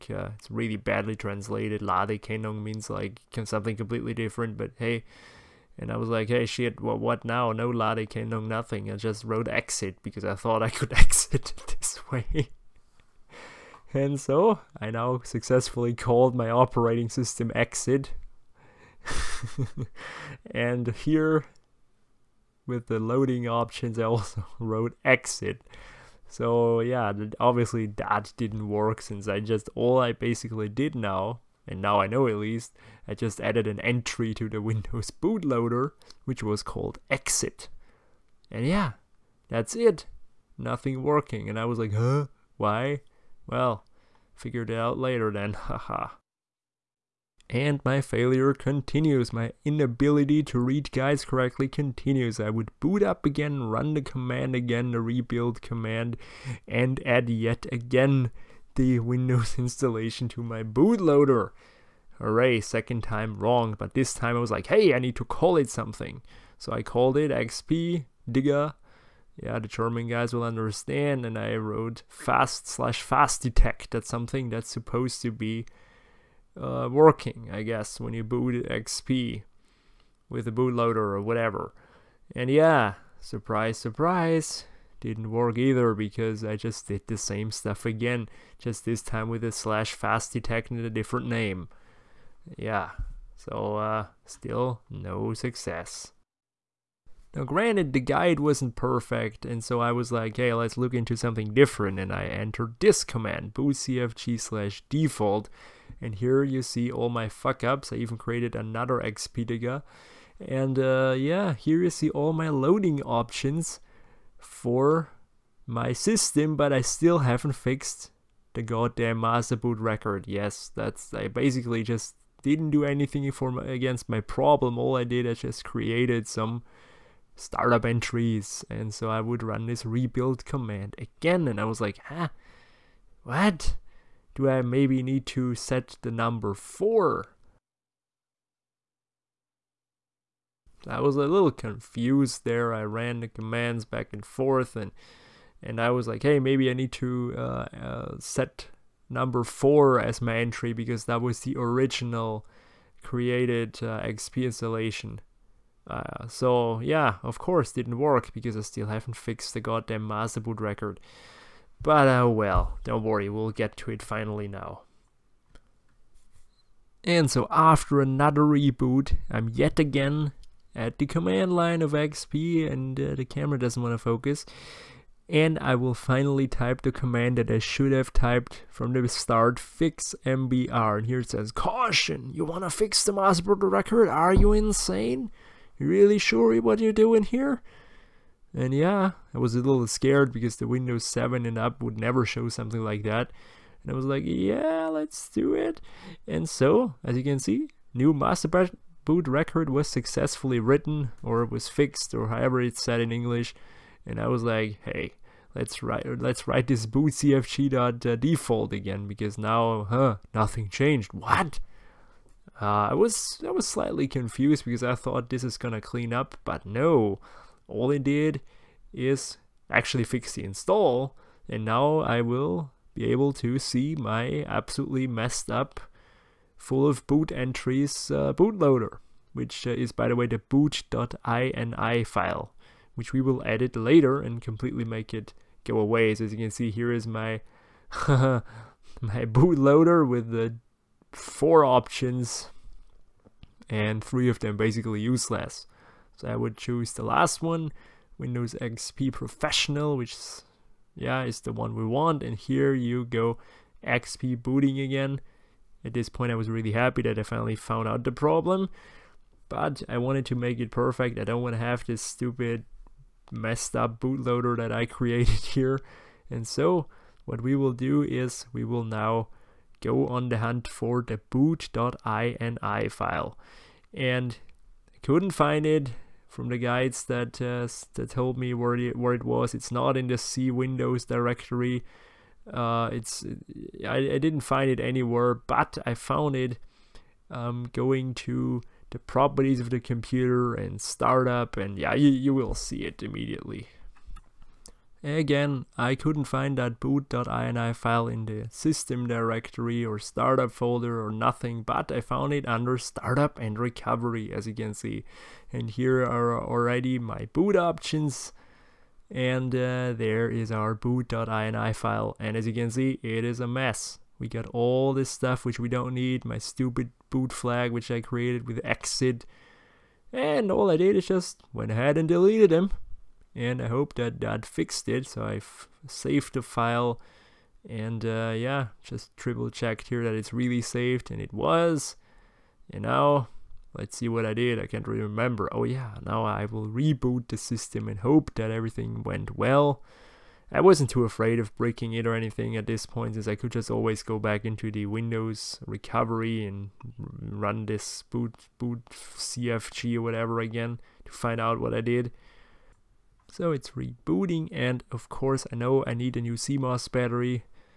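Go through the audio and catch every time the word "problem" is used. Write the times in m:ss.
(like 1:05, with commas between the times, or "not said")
2:04, 4:18.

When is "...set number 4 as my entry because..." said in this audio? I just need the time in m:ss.
2:28.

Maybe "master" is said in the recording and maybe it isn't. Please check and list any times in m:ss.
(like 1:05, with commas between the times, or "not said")
1:59, 2:40, 3:03, 3:18.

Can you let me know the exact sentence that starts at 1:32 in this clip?
Yeah, so uh, still no success.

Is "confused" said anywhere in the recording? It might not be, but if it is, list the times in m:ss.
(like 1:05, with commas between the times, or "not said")
2:21, 3:34.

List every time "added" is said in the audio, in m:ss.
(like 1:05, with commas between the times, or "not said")
0:33.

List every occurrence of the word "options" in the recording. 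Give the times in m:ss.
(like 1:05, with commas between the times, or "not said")
0:23, 1:53, 4:01, 5:07.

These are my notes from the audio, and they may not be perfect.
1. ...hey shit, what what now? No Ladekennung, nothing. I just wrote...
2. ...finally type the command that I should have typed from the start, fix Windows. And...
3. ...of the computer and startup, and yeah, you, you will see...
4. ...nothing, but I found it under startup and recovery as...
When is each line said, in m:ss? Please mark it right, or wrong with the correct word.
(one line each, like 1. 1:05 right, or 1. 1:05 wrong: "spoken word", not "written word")
1. 0:06 right
2. 2:55 wrong: "MBR", not "Windows"
3. 4:49 right
4. 5:01 right.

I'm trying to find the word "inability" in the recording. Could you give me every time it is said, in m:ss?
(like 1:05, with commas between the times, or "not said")
0:49.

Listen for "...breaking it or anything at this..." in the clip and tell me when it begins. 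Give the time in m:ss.
5:41.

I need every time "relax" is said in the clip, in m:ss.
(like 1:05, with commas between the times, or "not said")
not said.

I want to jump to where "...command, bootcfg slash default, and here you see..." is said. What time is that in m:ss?
1:43.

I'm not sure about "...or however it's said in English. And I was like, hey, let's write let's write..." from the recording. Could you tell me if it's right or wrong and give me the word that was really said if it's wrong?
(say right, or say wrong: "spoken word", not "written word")
right.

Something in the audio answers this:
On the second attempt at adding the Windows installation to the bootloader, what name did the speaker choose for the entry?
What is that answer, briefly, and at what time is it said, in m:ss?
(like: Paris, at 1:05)
XP Digger, at 1:07.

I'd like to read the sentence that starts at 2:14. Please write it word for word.
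do I maybe need to set the number 4?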